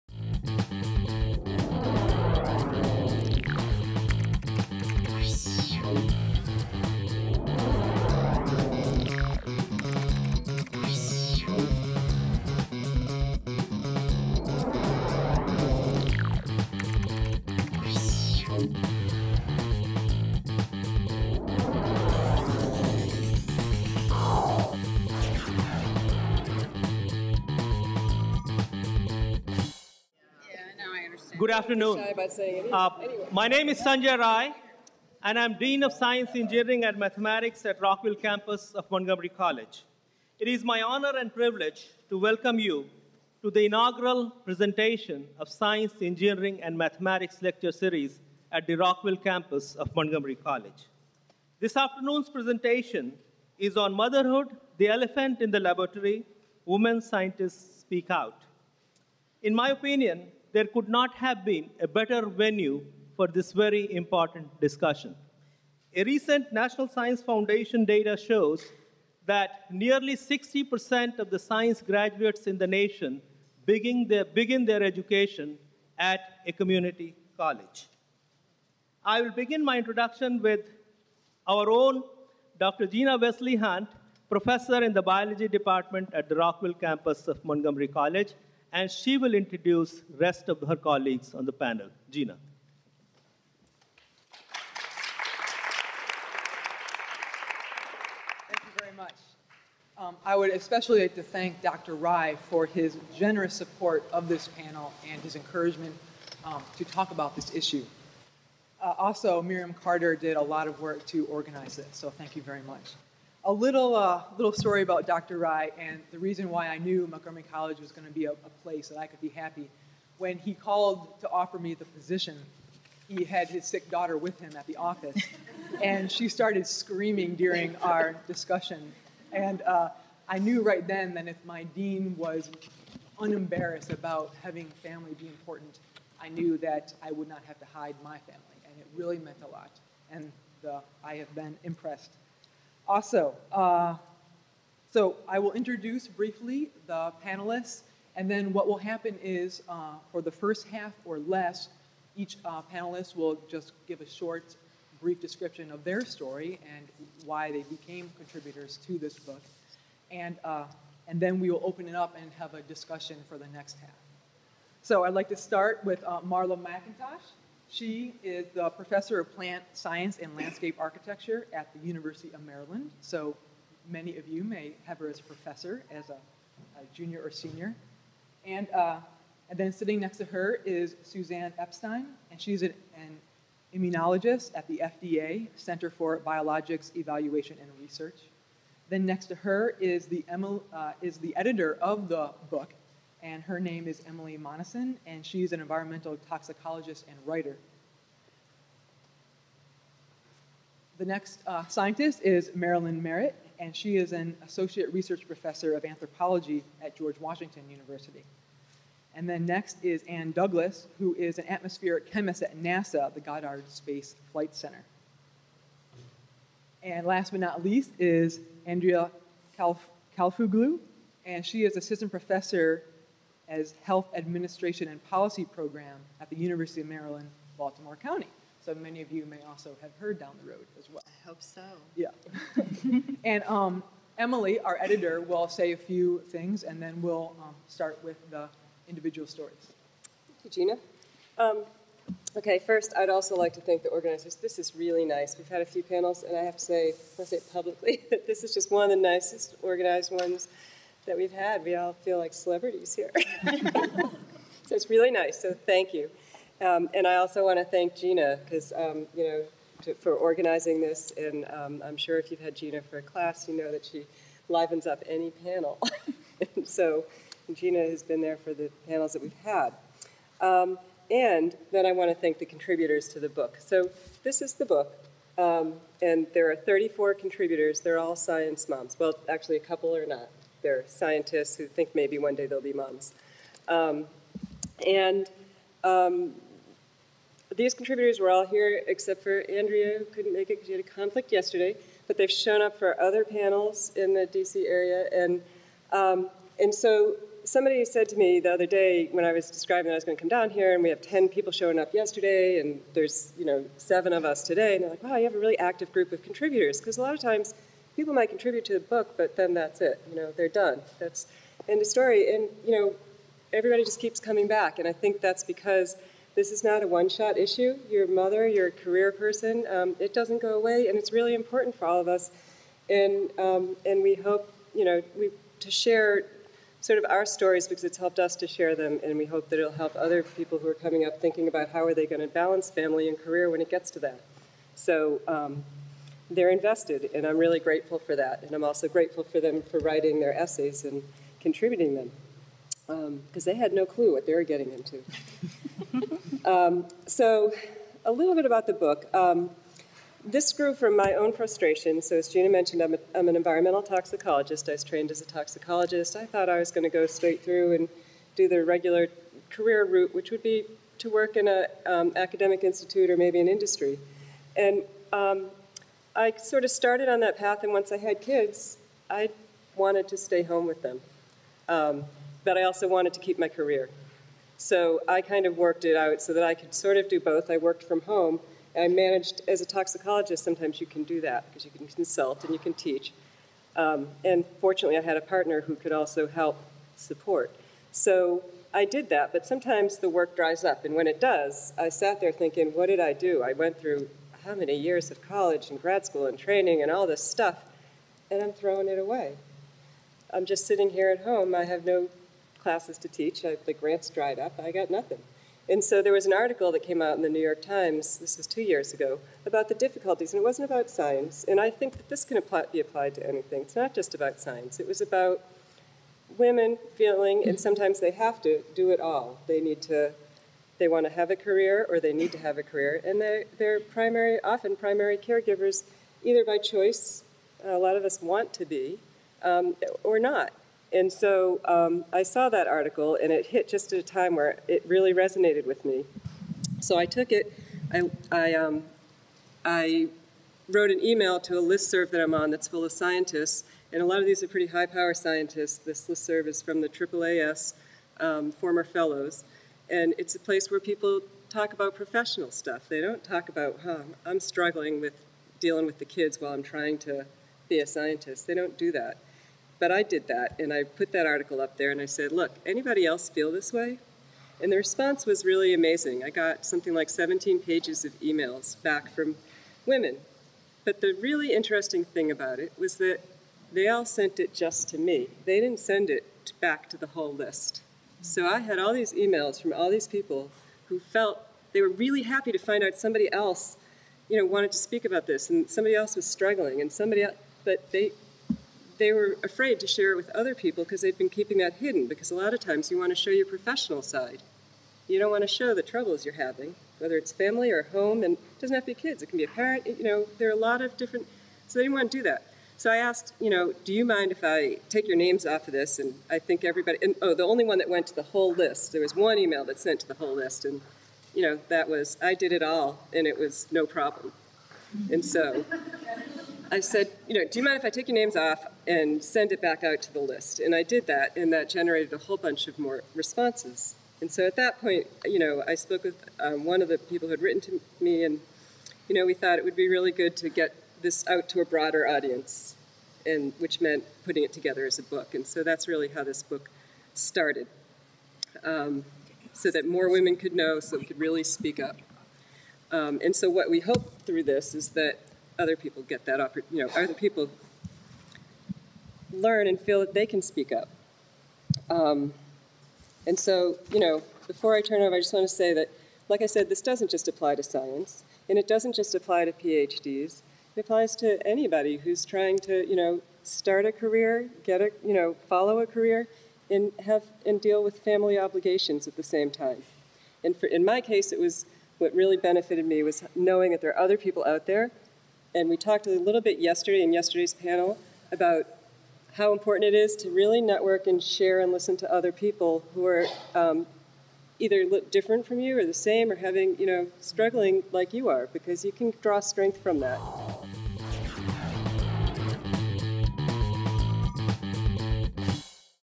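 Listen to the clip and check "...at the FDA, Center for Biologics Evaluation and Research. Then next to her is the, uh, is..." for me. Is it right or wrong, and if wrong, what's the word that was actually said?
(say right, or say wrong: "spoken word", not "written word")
right.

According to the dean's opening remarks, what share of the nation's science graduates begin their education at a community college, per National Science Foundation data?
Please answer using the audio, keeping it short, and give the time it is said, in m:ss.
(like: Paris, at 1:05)
nearly 60%, at 1:09.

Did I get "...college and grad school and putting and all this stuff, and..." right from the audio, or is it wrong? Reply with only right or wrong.
wrong.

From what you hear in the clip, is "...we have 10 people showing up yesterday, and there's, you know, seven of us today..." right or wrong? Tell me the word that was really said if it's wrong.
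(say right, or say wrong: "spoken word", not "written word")
right.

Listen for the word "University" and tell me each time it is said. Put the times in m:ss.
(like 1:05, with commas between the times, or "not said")
2:51, 3:27, 3:46.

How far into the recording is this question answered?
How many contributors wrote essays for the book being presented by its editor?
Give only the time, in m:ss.
4:36.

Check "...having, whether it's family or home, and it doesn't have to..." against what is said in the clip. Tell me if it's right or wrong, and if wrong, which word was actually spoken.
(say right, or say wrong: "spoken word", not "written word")
right.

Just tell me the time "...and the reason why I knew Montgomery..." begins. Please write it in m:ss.
1:55.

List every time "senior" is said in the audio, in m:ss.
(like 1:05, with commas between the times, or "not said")
2:57.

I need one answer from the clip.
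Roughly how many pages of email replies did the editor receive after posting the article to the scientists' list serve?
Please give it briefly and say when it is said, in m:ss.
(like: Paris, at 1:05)
17 pages, at 7:47.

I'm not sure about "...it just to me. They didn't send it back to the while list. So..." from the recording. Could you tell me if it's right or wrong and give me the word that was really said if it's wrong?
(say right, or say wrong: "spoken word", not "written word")
wrong: "whole", not "while".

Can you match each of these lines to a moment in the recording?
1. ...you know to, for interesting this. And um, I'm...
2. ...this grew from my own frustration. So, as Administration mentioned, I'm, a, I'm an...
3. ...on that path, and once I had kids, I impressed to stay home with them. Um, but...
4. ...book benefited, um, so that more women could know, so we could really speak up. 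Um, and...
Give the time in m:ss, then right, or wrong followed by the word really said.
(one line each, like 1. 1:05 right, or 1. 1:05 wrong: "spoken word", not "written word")
1. 4:19 wrong: "organizing", not "interesting"
2. 5:50 wrong: "Gina", not "Administration"
3. 6:07 wrong: "wanted", not "impressed"
4. 8:56 wrong: "started", not "benefited".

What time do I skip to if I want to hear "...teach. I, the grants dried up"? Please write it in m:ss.
6:43.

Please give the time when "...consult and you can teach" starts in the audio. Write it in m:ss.
6:21.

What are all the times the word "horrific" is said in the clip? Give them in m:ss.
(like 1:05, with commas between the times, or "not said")
not said.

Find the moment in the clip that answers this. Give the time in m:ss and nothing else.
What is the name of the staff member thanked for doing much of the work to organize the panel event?
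1:49.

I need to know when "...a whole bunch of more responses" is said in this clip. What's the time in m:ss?
8:42.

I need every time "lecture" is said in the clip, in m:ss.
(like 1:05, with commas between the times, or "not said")
0:47.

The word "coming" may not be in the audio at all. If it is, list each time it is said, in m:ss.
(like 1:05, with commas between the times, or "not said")
5:14, 5:30.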